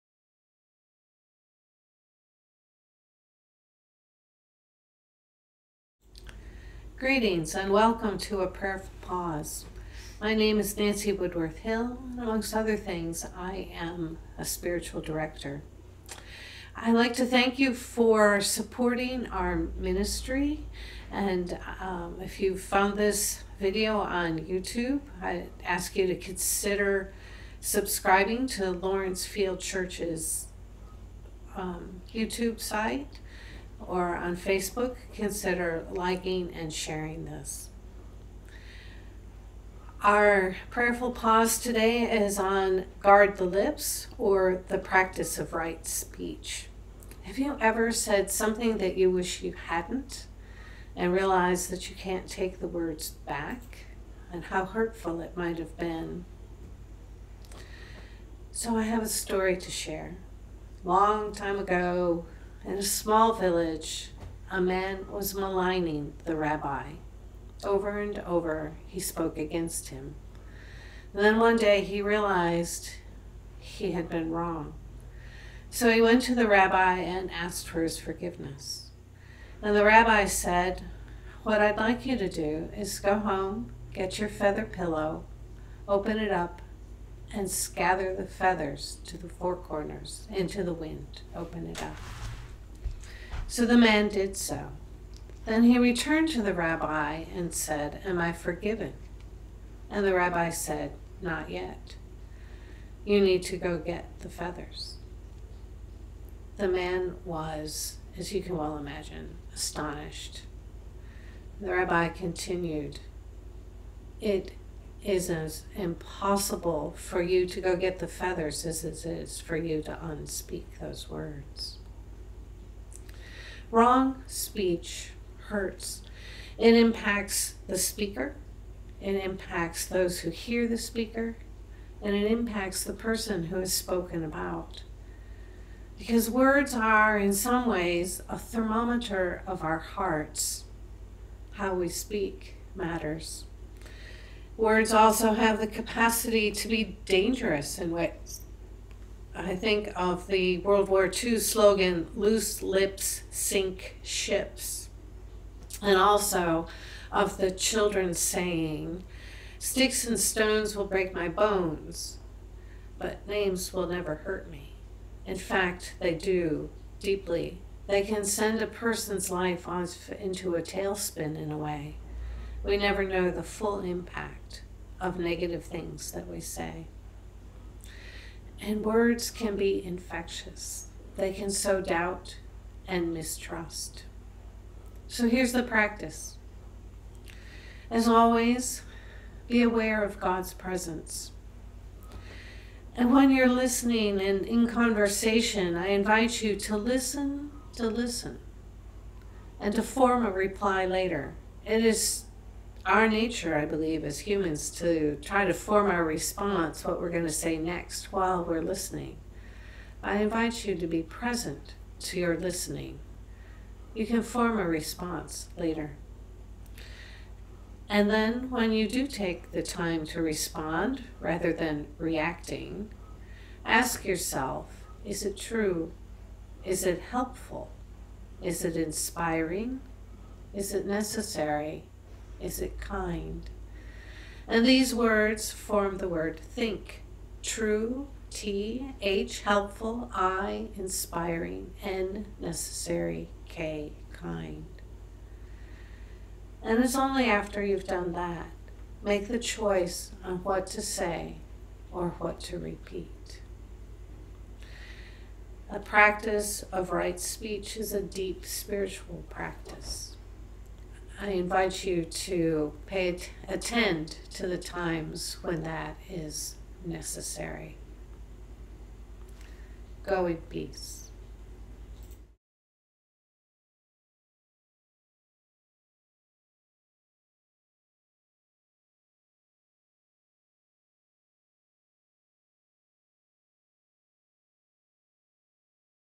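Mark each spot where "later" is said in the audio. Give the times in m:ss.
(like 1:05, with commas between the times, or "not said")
3:20, 3:35.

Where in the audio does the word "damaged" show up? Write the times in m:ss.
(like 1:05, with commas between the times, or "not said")
not said.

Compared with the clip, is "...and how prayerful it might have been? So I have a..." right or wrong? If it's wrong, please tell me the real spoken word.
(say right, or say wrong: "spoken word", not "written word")
wrong: "hurtful", not "prayerful".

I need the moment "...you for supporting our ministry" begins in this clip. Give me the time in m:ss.
0:17.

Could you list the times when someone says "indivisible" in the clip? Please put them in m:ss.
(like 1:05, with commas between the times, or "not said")
not said.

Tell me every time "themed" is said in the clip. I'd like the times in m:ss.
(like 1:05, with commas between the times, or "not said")
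not said.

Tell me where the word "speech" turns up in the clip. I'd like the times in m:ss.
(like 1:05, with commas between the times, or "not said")
0:45, 2:04, 4:17.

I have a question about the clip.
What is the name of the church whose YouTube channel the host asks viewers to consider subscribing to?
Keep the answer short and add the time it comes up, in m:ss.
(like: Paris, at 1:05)
Lawrencefield Church, at 0:28.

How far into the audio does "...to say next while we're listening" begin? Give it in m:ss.
3:27.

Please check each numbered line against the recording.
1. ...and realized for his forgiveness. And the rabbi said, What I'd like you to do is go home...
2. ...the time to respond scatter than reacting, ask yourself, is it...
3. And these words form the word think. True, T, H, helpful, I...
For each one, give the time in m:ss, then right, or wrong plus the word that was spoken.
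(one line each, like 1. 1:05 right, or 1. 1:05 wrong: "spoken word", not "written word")
1. 1:16 wrong: "asked", not "realized"
2. 3:39 wrong: "rather", not "scatter"
3. 3:54 right.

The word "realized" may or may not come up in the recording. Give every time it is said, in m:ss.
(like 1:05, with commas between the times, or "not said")
0:51, 1:12.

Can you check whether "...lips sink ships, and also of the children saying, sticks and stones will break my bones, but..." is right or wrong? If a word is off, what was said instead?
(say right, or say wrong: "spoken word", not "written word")
right.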